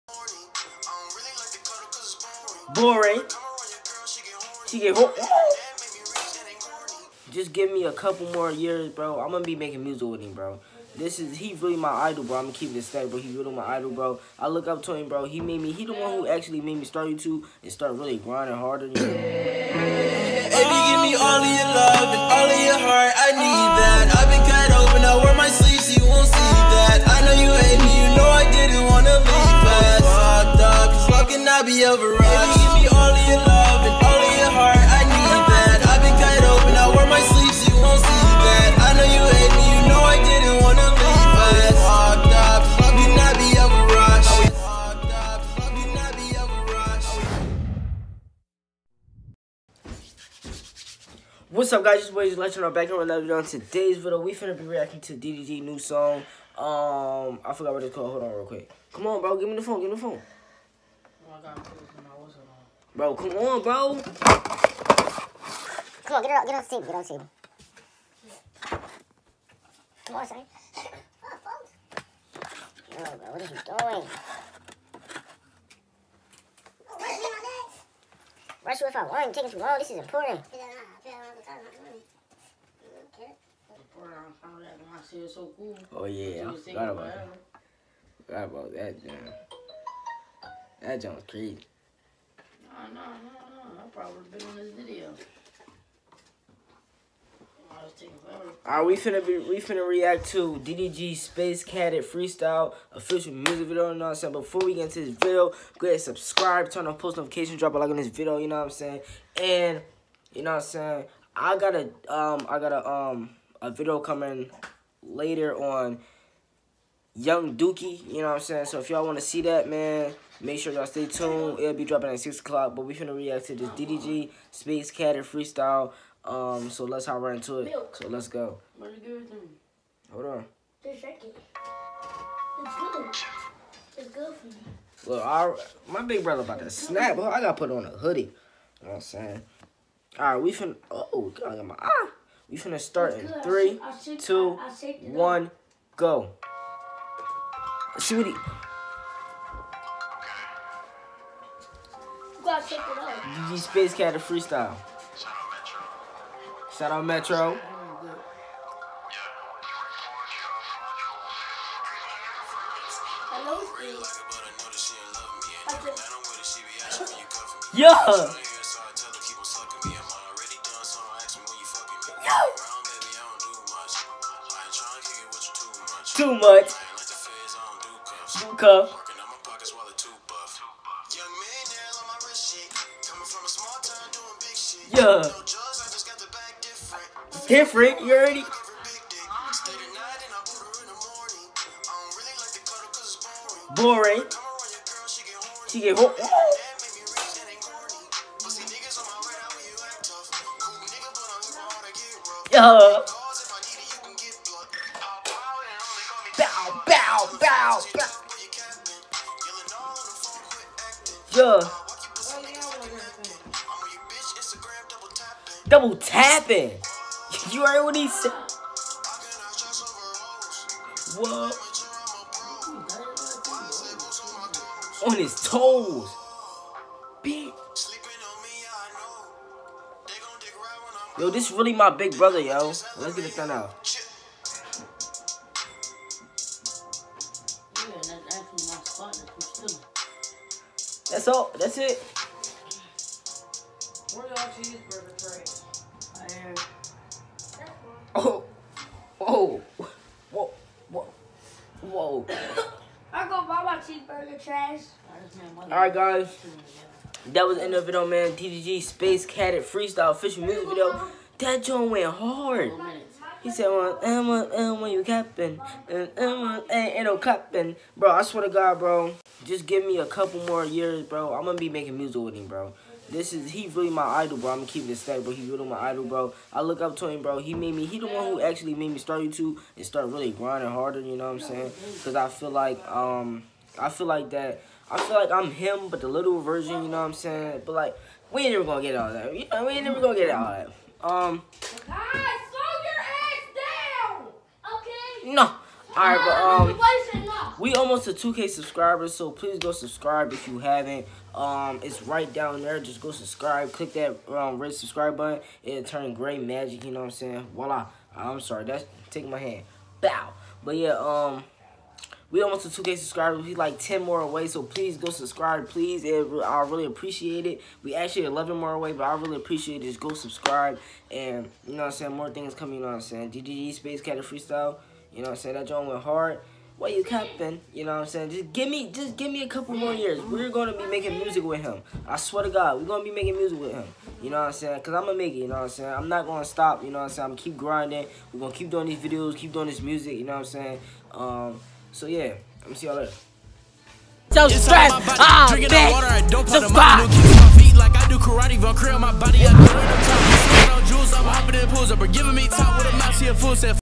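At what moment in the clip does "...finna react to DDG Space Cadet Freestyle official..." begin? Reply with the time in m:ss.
1:39.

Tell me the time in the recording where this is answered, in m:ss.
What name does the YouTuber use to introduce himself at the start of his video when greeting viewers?
0:52.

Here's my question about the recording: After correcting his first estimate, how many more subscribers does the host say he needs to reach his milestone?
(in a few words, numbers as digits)
11.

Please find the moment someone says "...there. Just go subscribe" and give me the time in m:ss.
5:02.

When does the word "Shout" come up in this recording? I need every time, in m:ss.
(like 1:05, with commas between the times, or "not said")
2:36.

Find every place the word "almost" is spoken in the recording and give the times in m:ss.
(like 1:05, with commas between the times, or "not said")
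4:57, 5:12.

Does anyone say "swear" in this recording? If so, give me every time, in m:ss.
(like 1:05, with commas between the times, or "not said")
4:28, 5:32.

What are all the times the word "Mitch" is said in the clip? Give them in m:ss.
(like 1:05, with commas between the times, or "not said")
not said.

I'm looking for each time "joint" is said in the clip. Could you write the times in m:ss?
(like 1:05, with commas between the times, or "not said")
4:21, 5:25.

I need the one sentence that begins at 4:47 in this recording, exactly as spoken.
But, like, we ain't never going to get all that.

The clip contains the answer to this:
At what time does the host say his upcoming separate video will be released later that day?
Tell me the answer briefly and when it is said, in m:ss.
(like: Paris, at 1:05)
6 o'clock, at 2:02.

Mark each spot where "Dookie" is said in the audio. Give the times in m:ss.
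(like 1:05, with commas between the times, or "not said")
1:57.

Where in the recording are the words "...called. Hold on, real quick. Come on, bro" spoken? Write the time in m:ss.
0:57.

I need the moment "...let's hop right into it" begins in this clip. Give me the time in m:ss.
2:06.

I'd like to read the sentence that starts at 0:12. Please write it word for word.
I'm gonna keep this steady, bro.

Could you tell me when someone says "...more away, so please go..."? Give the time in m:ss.
5:14.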